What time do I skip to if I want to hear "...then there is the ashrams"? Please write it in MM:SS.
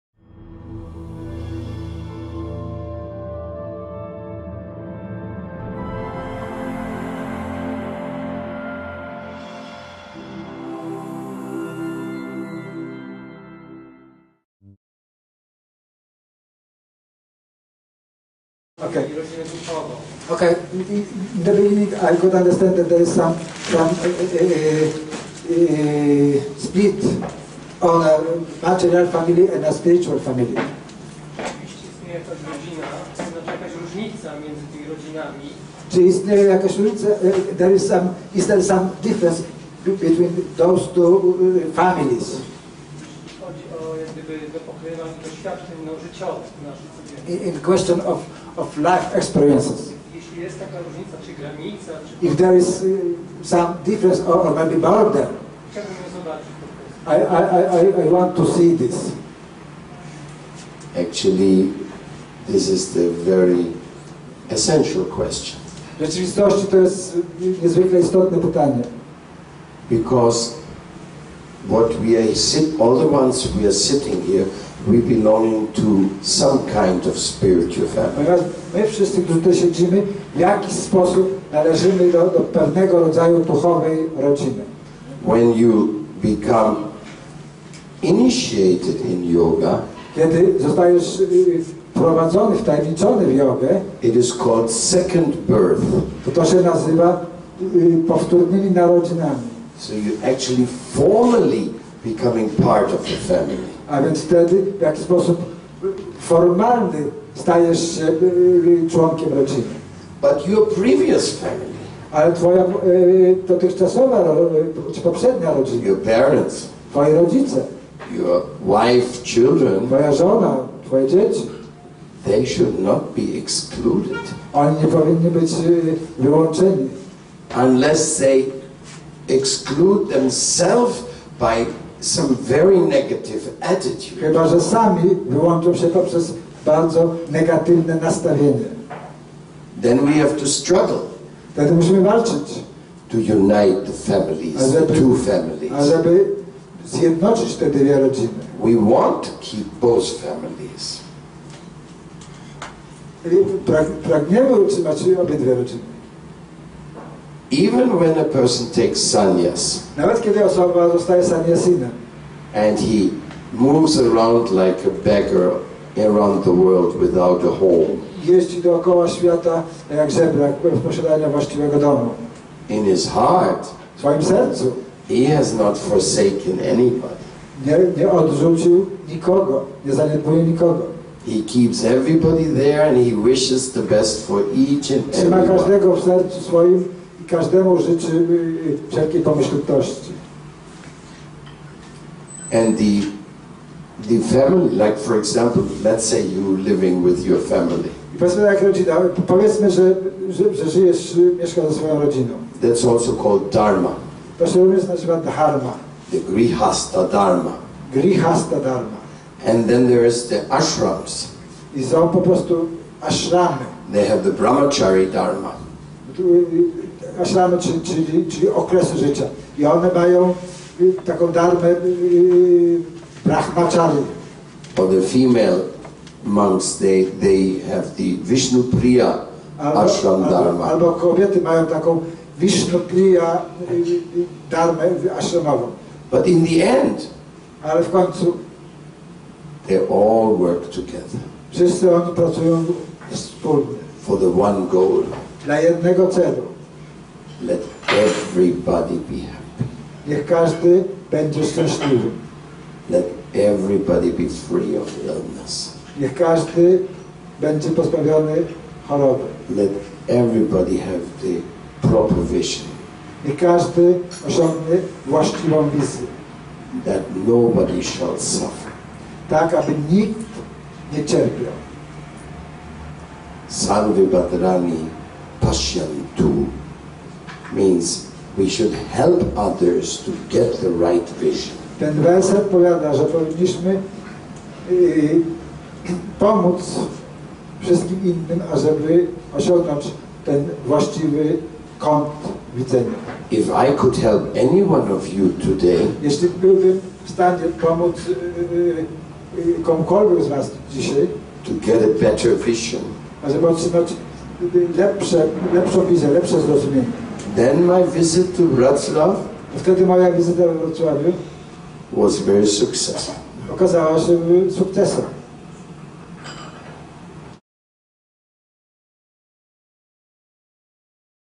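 03:29.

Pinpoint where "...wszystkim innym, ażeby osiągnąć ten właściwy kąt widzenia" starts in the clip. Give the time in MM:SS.
04:47.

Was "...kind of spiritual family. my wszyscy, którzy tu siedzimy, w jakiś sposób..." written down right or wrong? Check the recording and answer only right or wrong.
right.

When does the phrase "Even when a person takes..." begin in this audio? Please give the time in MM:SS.
02:37.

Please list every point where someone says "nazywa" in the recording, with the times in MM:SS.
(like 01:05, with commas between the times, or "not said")
01:36, 03:24.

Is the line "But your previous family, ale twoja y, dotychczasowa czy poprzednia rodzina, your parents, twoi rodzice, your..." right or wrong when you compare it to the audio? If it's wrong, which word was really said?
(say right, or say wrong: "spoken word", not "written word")
right.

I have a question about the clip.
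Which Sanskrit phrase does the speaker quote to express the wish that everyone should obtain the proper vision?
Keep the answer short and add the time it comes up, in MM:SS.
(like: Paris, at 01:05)
Salve Badrani Pasyantu, at 04:33.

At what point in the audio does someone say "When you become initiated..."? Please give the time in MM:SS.
01:25.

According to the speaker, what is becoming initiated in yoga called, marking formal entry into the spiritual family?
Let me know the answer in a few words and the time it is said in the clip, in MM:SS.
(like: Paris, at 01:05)
second birth, at 01:34.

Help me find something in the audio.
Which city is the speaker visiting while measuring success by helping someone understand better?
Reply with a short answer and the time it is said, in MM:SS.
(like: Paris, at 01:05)
Wrocław, at 05:08.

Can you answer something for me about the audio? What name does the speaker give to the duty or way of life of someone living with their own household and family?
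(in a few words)
grihasta dharma.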